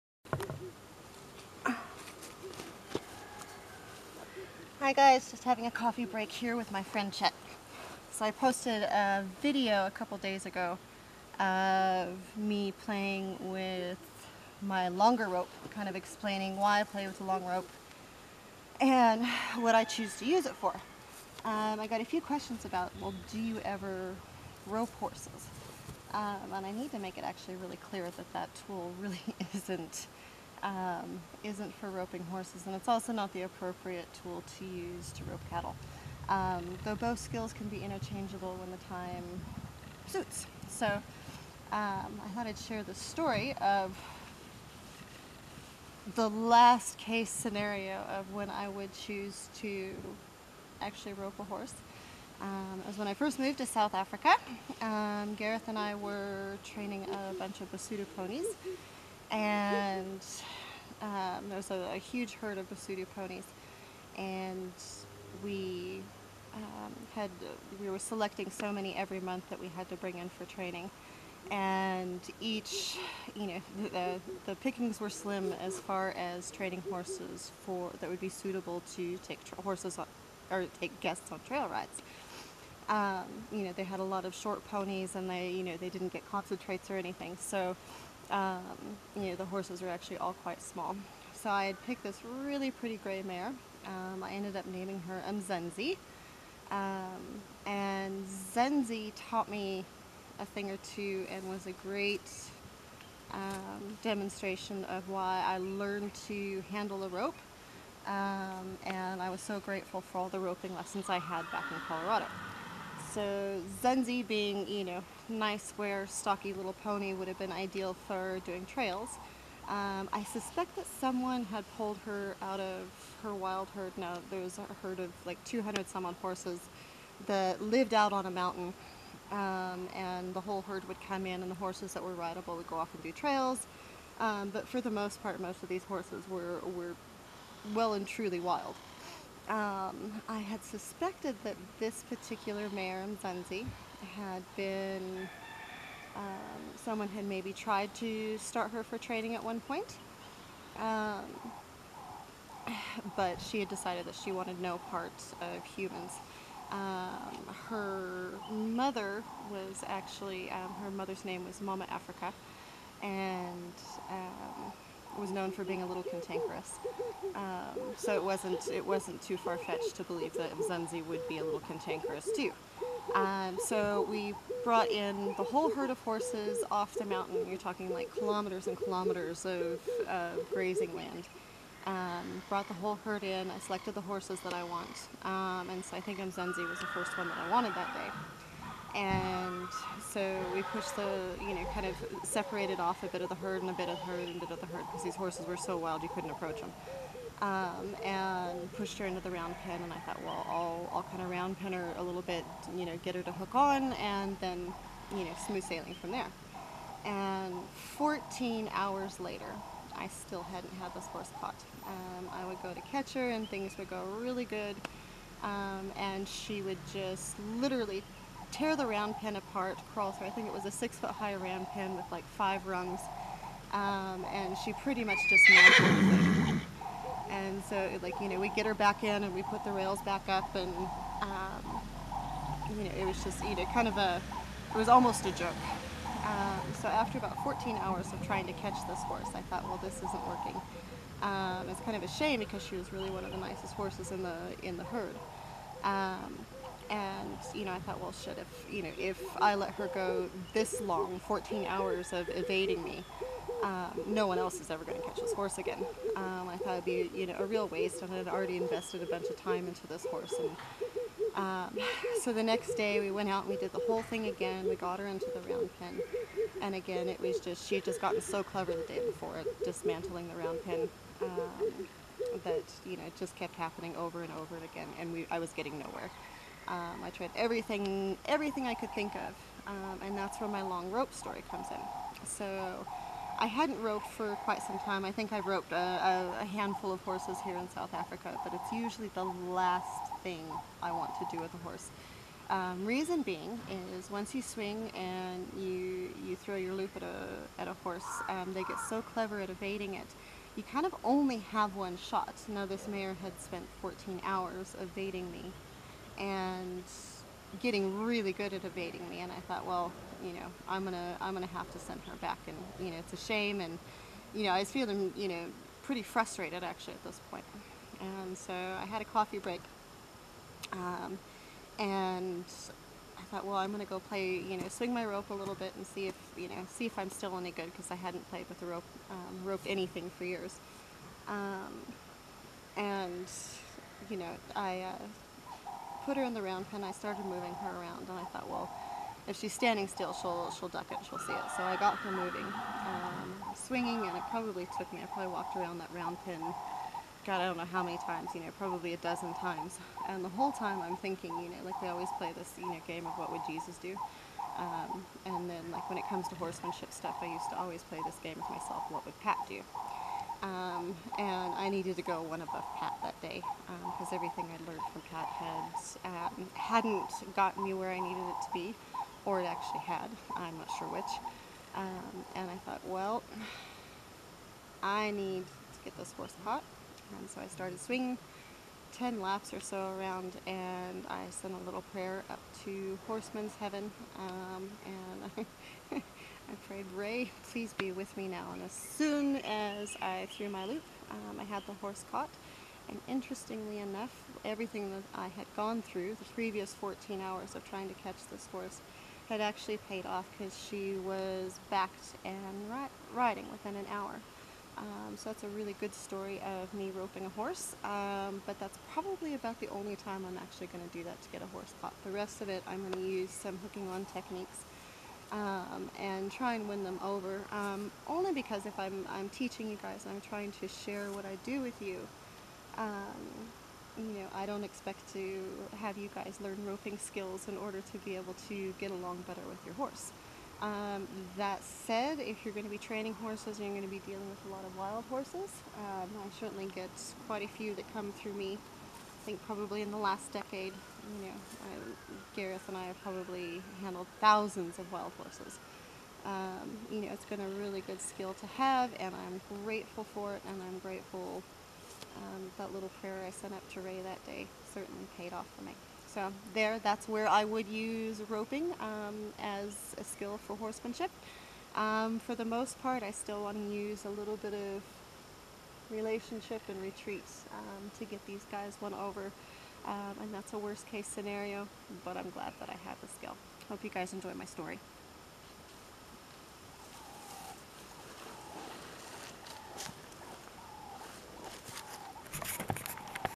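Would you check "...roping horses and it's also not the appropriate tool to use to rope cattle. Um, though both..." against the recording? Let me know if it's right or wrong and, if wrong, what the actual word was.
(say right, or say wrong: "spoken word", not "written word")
right.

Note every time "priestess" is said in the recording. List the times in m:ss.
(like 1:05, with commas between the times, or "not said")
not said.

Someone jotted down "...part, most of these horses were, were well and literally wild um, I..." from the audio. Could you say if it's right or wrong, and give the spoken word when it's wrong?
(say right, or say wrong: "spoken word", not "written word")
wrong: "truly", not "literally".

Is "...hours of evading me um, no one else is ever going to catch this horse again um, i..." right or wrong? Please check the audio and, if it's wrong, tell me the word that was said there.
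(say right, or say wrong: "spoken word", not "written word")
right.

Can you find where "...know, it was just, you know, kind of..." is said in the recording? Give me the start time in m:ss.
3:52.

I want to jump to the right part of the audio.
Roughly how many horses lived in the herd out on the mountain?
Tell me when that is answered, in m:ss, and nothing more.
2:05.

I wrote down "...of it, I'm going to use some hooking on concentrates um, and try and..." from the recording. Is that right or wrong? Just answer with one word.
wrong.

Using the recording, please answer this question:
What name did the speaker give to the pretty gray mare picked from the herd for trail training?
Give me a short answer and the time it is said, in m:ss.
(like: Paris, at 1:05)
Mzenzi, at 1:35.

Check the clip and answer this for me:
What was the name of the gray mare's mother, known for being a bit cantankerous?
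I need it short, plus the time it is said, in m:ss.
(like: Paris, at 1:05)
Mama Africa, at 2:41.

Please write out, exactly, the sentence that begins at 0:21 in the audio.
Um, I got a few questions about, well, do you ever rope horses?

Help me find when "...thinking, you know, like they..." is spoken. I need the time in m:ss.
5:50.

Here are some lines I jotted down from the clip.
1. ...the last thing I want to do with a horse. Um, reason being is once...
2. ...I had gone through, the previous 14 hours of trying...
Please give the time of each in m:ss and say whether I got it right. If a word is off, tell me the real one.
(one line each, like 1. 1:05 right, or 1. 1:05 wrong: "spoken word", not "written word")
1. 4:49 right
2. 6:35 right.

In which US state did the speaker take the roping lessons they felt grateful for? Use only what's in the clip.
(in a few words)
Colorado.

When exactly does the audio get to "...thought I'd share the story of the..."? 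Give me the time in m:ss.
0:42.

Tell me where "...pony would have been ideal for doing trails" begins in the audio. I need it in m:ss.
1:56.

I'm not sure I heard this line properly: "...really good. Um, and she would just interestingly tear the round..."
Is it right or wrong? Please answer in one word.
wrong.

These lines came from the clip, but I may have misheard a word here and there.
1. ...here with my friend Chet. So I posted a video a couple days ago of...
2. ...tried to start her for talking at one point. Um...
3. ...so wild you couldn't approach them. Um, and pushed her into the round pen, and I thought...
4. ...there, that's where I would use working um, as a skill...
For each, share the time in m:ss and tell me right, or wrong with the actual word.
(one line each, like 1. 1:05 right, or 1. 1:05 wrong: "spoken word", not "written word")
1. 0:06 right
2. 2:27 wrong: "training", not "talking"
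3. 3:15 right
4. 7:36 wrong: "roping", not "working".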